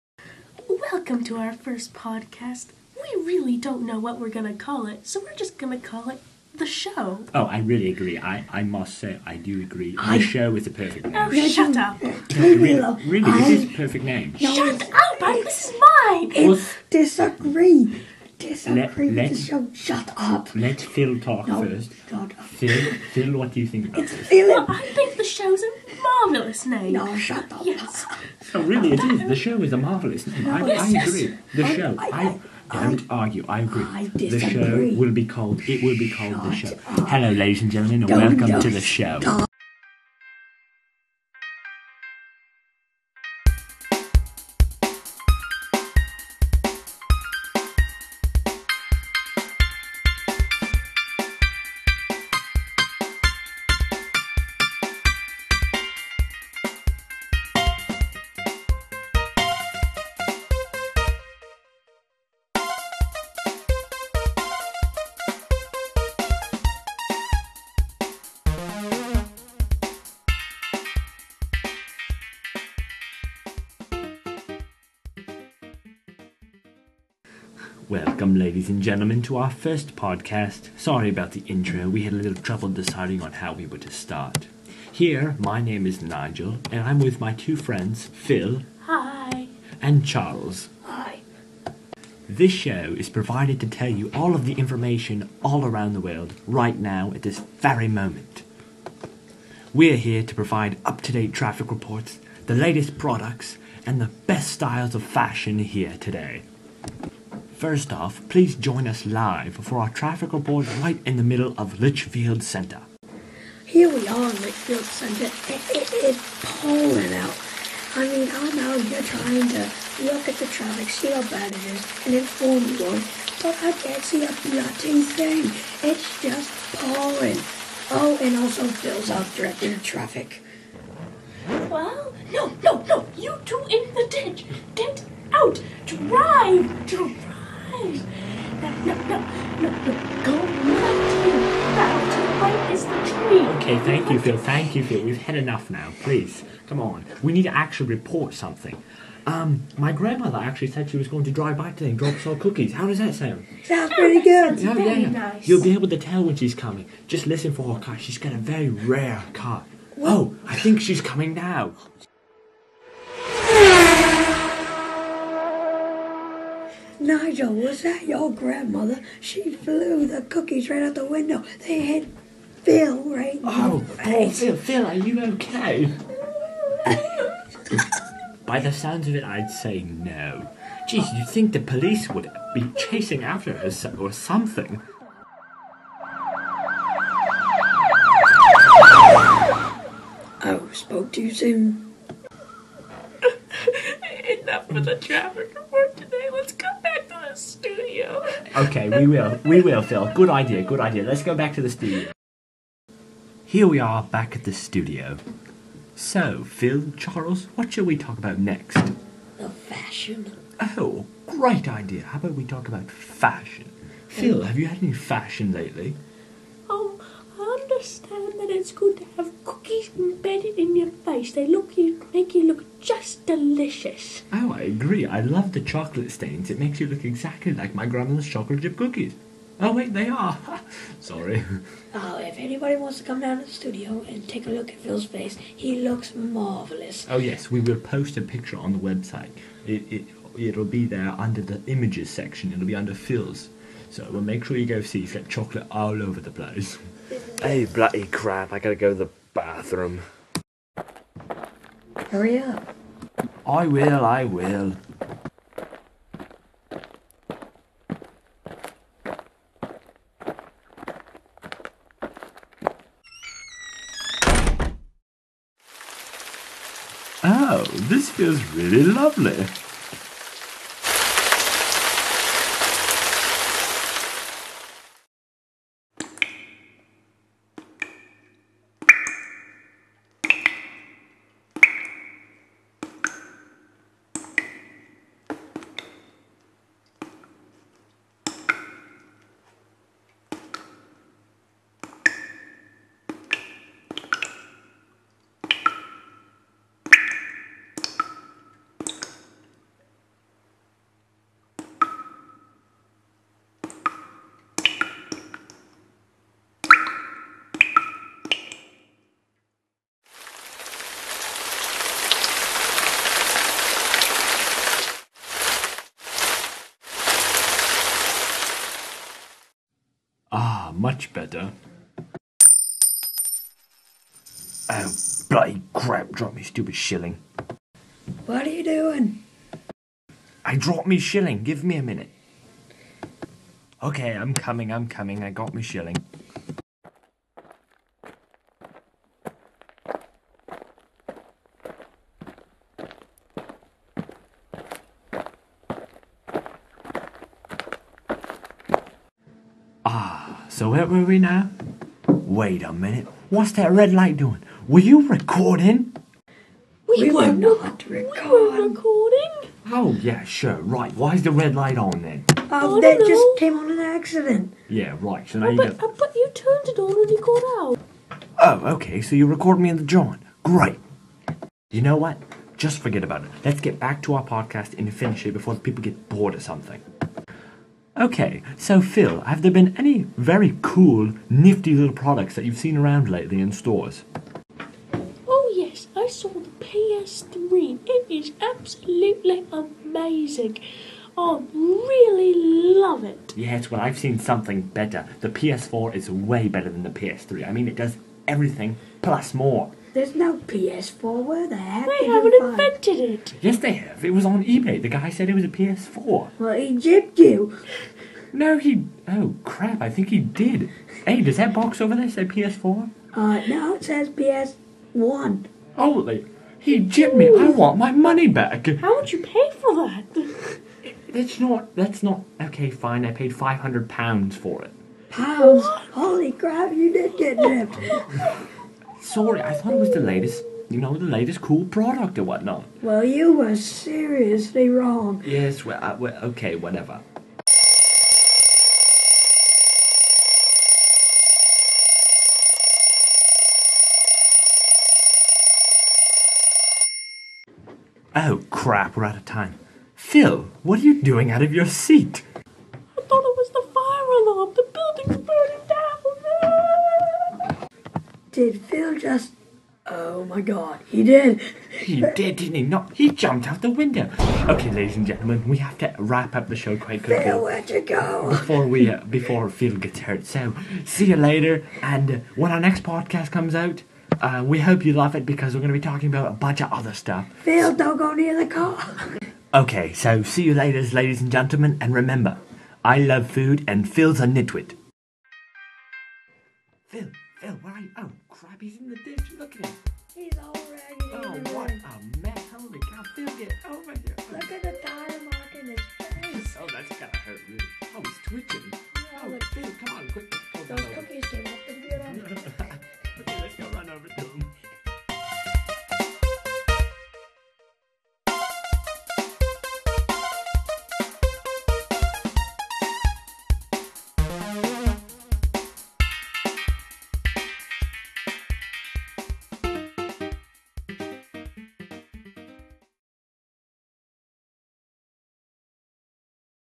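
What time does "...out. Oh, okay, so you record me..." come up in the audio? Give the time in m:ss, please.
6:07.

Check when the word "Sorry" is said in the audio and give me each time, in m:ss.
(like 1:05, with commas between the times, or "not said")
1:20, 3:50, 7:09.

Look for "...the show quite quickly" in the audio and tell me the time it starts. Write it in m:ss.
7:46.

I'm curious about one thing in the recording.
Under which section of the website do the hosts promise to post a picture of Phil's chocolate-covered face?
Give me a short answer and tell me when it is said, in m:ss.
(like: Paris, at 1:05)
images section, at 4:01.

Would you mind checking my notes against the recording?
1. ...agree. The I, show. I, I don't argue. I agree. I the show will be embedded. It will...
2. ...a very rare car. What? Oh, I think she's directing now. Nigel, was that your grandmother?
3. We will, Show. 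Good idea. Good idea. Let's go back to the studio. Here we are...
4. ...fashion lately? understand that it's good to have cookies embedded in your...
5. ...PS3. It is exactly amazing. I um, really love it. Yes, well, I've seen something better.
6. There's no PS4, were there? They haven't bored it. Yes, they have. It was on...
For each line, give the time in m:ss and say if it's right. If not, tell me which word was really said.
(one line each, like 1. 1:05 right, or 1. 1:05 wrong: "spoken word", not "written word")
1. 0:31 wrong: "called", not "embedded"
2. 2:38 wrong: "coming", not "directing"
3. 3:19 wrong: "Phil", not "Show"
4. 3:34 right
5. 6:26 wrong: "absolutely", not "exactly"
6. 6:39 wrong: "invented", not "bored".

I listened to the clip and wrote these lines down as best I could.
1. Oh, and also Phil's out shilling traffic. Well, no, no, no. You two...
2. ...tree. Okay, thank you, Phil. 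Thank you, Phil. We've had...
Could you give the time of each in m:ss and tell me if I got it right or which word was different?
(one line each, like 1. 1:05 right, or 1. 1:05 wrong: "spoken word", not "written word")
1. 2:07 wrong: "directing", not "shilling"
2. 2:23 right.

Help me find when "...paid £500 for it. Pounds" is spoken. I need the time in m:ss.
7:03.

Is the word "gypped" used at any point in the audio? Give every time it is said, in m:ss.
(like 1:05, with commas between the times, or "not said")
6:46, 6:56, 7:07.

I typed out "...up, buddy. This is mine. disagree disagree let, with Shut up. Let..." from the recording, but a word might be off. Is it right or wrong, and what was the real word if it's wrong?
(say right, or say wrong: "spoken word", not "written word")
right.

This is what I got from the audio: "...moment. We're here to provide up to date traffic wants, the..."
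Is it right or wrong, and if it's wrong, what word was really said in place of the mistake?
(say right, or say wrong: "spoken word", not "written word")
wrong: "reports", not "wants".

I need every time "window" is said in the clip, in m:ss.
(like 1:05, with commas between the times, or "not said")
2:51, 7:43.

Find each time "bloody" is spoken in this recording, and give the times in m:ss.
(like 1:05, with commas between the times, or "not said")
2:04, 4:07, 5:25.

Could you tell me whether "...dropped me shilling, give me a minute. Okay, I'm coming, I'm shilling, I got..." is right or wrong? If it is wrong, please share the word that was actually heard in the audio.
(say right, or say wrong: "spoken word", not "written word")
wrong: "coming", not "shilling".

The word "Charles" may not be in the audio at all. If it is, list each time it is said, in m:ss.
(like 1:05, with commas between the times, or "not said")
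1:30, 3:26.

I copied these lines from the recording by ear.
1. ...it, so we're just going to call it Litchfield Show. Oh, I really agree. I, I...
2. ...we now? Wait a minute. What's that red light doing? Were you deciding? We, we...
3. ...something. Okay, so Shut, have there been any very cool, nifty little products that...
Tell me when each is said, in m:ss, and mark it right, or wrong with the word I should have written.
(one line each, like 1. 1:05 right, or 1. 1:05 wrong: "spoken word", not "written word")
1. 0:04 wrong: "The", not "Litchfield"
2. 5:51 wrong: "recording", not "deciding"
3. 6:16 wrong: "Phil", not "Shut".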